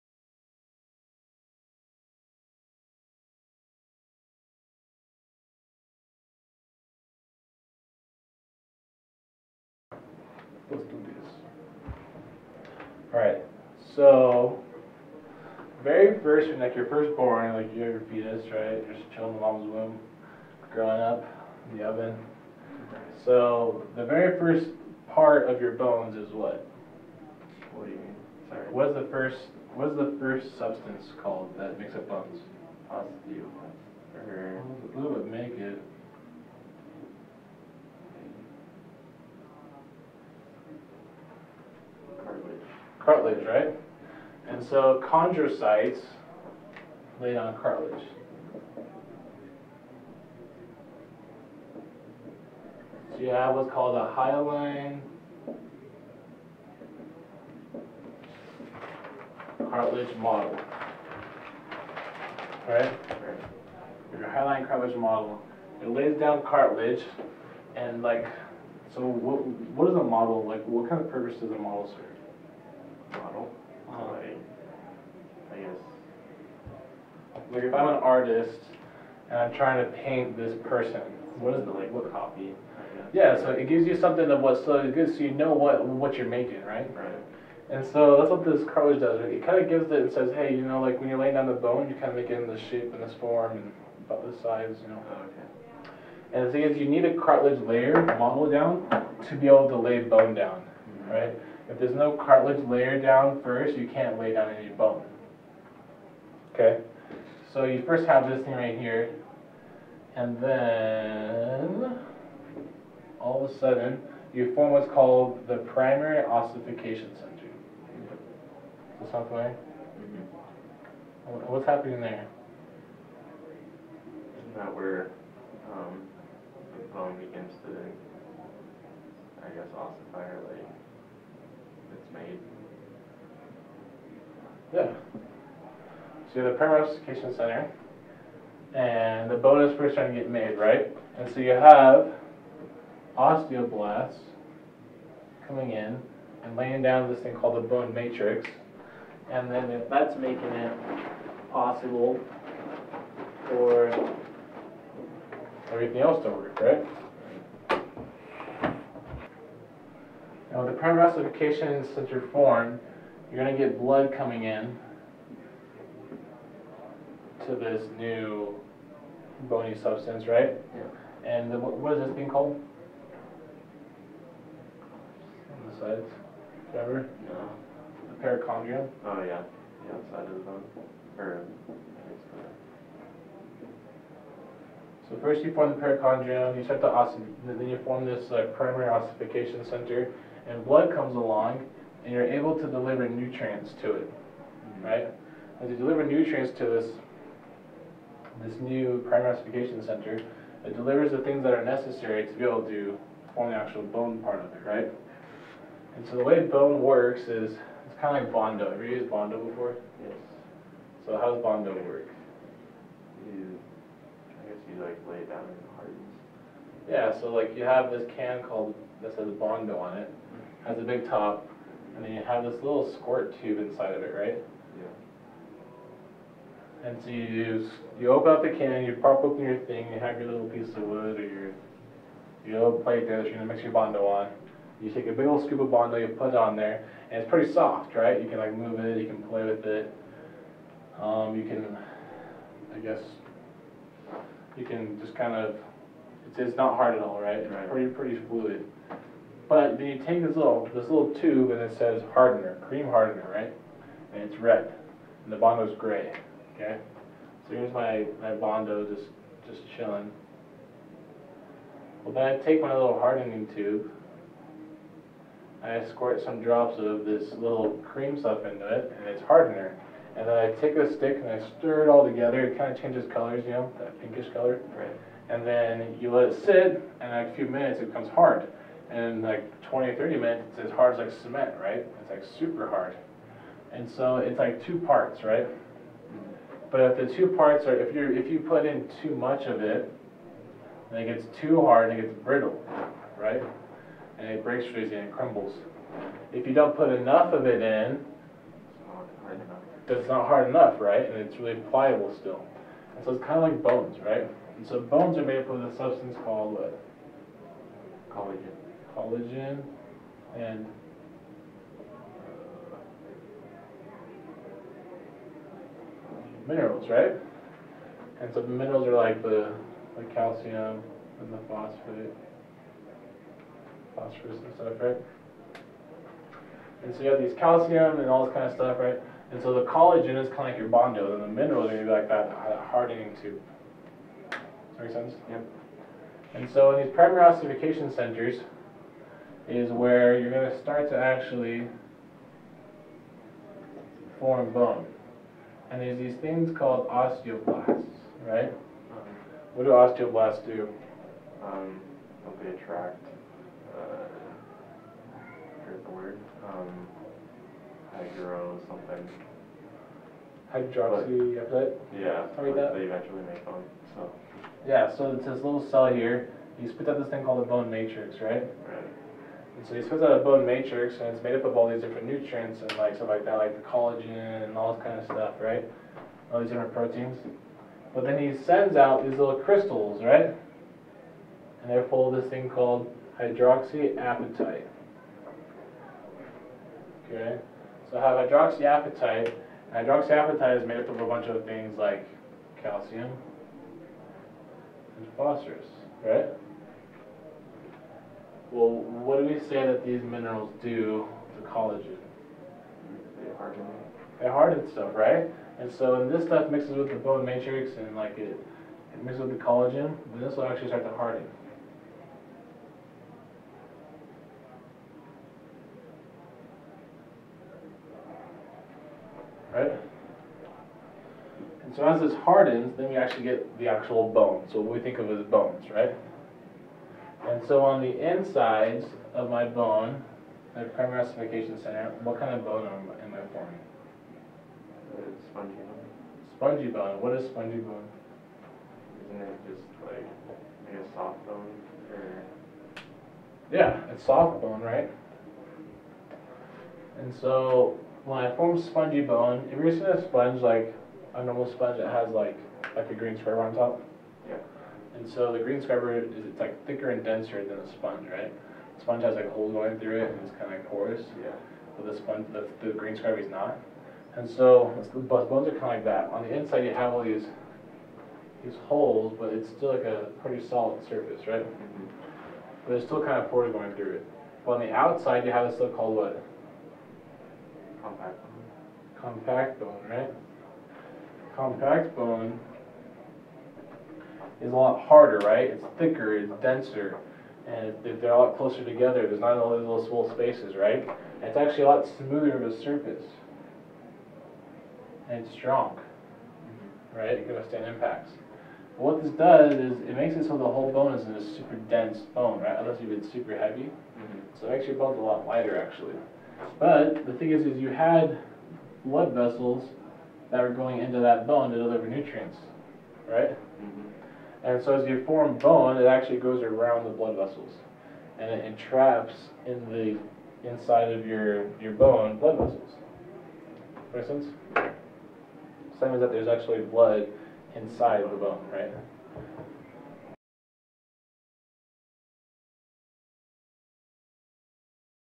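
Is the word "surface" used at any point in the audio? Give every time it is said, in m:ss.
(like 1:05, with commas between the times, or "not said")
7:50, 8:12.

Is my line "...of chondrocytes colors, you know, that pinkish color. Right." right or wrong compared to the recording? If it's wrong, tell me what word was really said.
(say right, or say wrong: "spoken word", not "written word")
wrong: "changes", not "chondrocytes".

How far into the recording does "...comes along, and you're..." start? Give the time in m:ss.
3:10.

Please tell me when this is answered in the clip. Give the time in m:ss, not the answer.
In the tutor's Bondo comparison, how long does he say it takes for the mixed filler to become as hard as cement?
4:39.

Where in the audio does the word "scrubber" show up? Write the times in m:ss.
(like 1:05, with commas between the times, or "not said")
7:35, 7:42.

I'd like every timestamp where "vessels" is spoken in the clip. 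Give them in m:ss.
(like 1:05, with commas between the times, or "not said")
8:29, 8:37, 8:42.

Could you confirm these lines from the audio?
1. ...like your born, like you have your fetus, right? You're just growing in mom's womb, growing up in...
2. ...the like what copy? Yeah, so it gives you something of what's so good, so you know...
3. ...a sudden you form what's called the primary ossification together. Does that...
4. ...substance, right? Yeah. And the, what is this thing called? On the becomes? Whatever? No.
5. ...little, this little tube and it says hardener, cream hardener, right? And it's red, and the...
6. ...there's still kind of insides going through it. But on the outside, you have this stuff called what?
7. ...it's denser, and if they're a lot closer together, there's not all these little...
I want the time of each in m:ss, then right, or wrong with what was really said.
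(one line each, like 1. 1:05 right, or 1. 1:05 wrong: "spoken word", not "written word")
1. 0:16 wrong: "chilling", not "growing"
2. 1:21 right
3. 1:53 wrong: "center", not "together"
4. 2:49 wrong: "sides", not "becomes"
5. 4:10 right
6. 7:52 wrong: "pores", not "insides"
7. 8:06 right.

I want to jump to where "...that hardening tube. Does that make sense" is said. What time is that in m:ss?
5:32.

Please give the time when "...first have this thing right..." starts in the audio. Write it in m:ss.
1:47.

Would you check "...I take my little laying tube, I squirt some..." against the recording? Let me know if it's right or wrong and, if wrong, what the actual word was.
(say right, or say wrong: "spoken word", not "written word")
wrong: "hardening", not "laying".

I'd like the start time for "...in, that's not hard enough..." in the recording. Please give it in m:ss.
4:57.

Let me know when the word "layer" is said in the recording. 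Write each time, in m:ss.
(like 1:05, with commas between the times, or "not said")
1:37, 1:42.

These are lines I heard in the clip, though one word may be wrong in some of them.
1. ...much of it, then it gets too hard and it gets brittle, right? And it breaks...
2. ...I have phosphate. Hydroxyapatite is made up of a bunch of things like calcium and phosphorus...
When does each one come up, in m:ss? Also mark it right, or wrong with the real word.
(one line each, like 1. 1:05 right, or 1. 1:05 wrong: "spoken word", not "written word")
1. 4:49 right
2. 6:27 wrong: "hydroxyapatite", not "phosphate".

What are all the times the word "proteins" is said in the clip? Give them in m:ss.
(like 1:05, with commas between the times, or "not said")
6:16.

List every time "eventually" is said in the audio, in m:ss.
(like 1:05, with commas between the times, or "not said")
6:02.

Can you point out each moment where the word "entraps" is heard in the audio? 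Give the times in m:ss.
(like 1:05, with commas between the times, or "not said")
8:38.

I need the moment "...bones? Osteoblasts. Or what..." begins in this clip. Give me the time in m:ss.
0:32.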